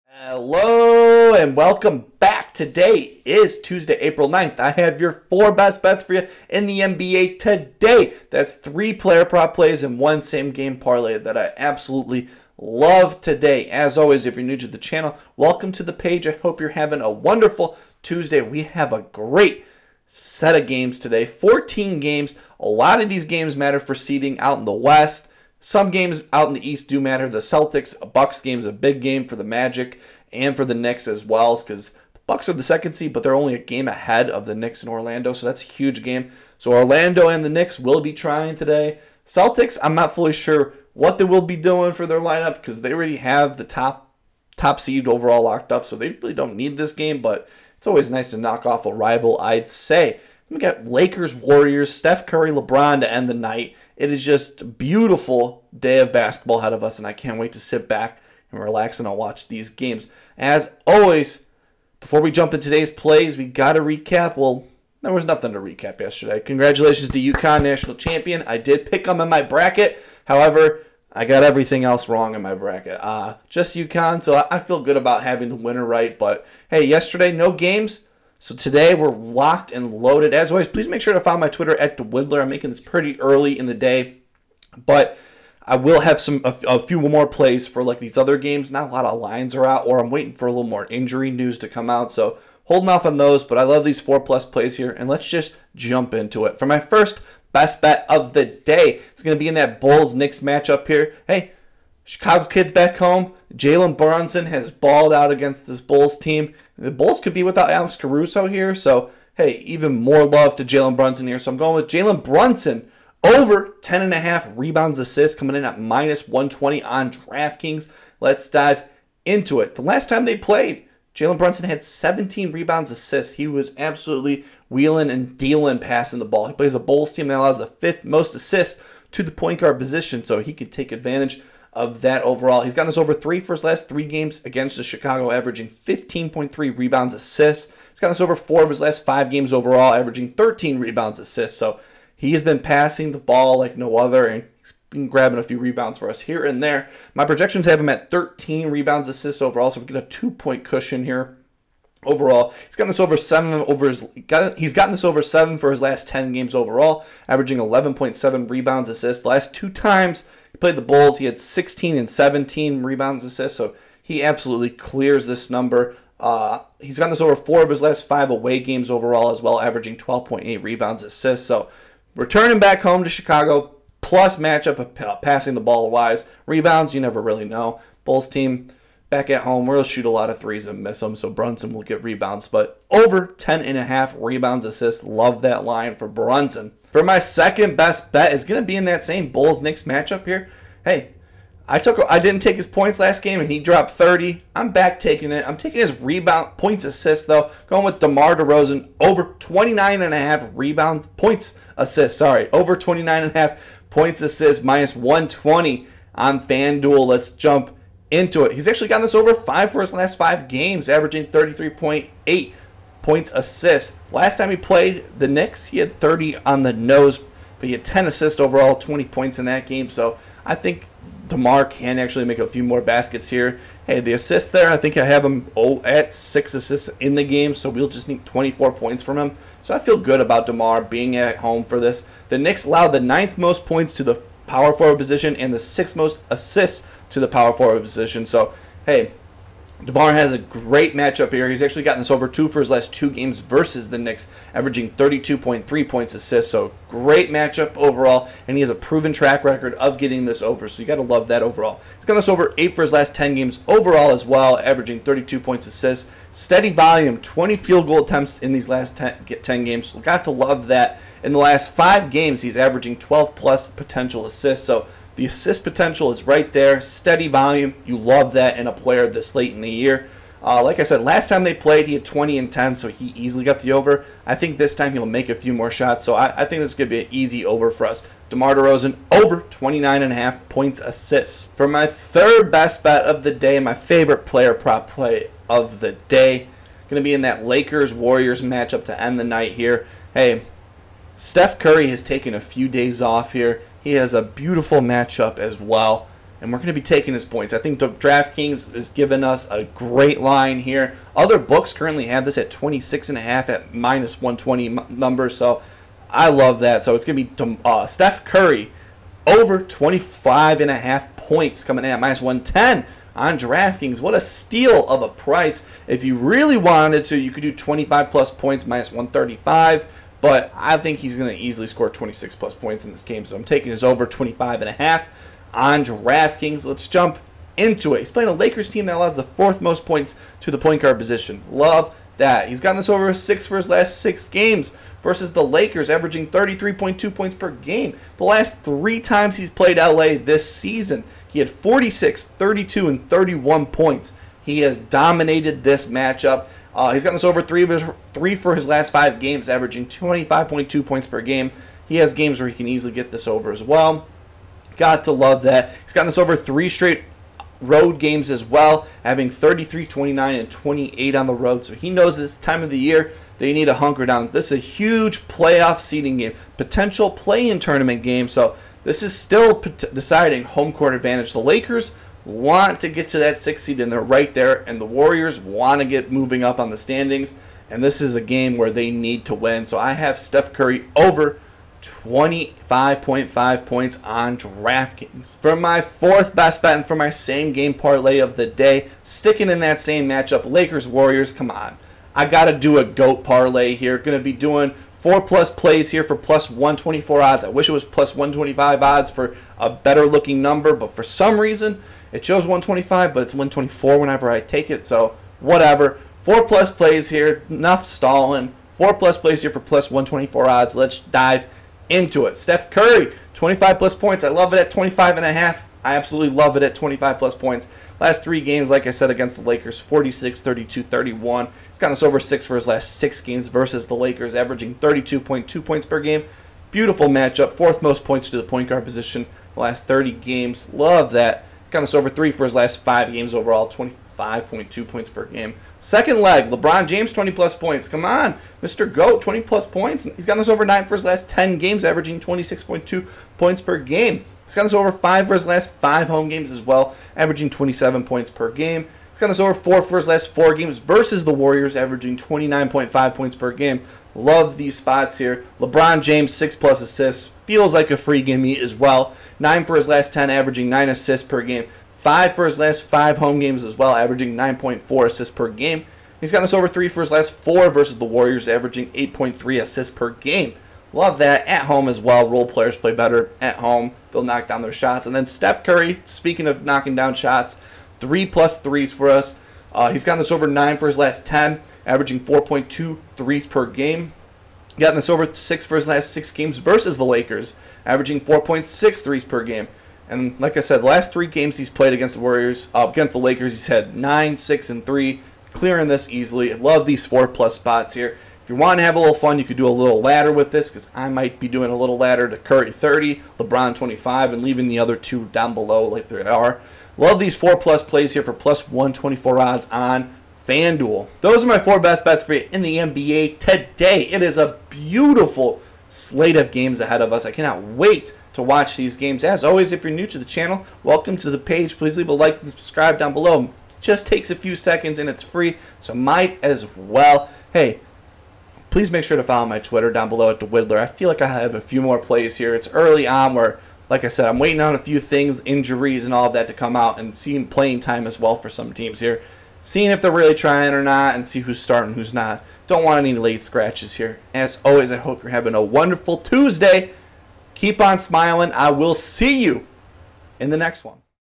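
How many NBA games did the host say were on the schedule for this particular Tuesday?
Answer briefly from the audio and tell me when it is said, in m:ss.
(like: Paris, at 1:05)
14, at 0:21.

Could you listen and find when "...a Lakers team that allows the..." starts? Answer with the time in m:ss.
5:28.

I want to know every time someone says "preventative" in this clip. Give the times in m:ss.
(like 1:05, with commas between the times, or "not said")
not said.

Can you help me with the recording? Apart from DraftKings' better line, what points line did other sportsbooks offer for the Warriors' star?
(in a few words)
26.5.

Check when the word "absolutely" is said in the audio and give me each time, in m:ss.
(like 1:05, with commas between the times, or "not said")
0:11, 2:03, 2:44, 6:55.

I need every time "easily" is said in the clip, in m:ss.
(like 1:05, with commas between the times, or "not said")
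4:33, 5:21, 5:52, 8:16.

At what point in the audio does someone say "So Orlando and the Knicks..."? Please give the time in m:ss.
0:36.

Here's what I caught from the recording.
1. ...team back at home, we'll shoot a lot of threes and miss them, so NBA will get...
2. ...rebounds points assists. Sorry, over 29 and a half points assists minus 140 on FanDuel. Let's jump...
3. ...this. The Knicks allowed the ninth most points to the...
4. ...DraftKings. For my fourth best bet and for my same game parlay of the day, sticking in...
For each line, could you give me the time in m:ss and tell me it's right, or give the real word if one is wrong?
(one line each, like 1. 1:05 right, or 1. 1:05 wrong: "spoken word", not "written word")
1. 2:58 wrong: "Brunson", not "NBA"
2. 3:20 wrong: "120", not "140"
3. 3:51 right
4. 6:24 right.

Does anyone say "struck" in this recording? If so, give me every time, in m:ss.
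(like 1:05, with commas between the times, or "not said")
not said.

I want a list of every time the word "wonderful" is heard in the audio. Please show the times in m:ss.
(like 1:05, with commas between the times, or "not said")
0:17, 9:05.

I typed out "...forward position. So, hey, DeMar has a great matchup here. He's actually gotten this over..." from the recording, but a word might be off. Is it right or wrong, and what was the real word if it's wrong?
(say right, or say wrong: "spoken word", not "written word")
right.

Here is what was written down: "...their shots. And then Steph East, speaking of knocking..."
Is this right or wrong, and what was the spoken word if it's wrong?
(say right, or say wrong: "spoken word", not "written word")
wrong: "Curry", not "East".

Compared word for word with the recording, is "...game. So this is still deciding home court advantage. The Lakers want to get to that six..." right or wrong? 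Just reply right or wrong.
right.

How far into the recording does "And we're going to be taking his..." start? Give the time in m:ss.
4:56.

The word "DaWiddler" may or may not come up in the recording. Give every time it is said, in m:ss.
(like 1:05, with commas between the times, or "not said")
1:21, 8:50.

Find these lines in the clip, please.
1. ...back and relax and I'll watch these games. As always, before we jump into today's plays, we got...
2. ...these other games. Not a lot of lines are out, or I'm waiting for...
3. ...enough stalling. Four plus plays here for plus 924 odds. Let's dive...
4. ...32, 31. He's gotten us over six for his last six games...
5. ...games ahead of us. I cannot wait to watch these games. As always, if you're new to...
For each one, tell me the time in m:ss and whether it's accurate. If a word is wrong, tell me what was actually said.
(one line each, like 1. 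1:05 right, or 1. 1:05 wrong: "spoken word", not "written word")
1. 0:57 right
2. 1:27 right
3. 6:47 wrong: "124", not "924"
4. 7:00 right
5. 8:36 right.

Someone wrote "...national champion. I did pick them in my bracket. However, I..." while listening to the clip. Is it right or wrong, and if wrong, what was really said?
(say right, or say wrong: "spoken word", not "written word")
right.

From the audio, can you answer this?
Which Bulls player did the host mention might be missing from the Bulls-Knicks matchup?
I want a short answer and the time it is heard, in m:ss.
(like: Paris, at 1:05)
Alex Caruso, at 1:47.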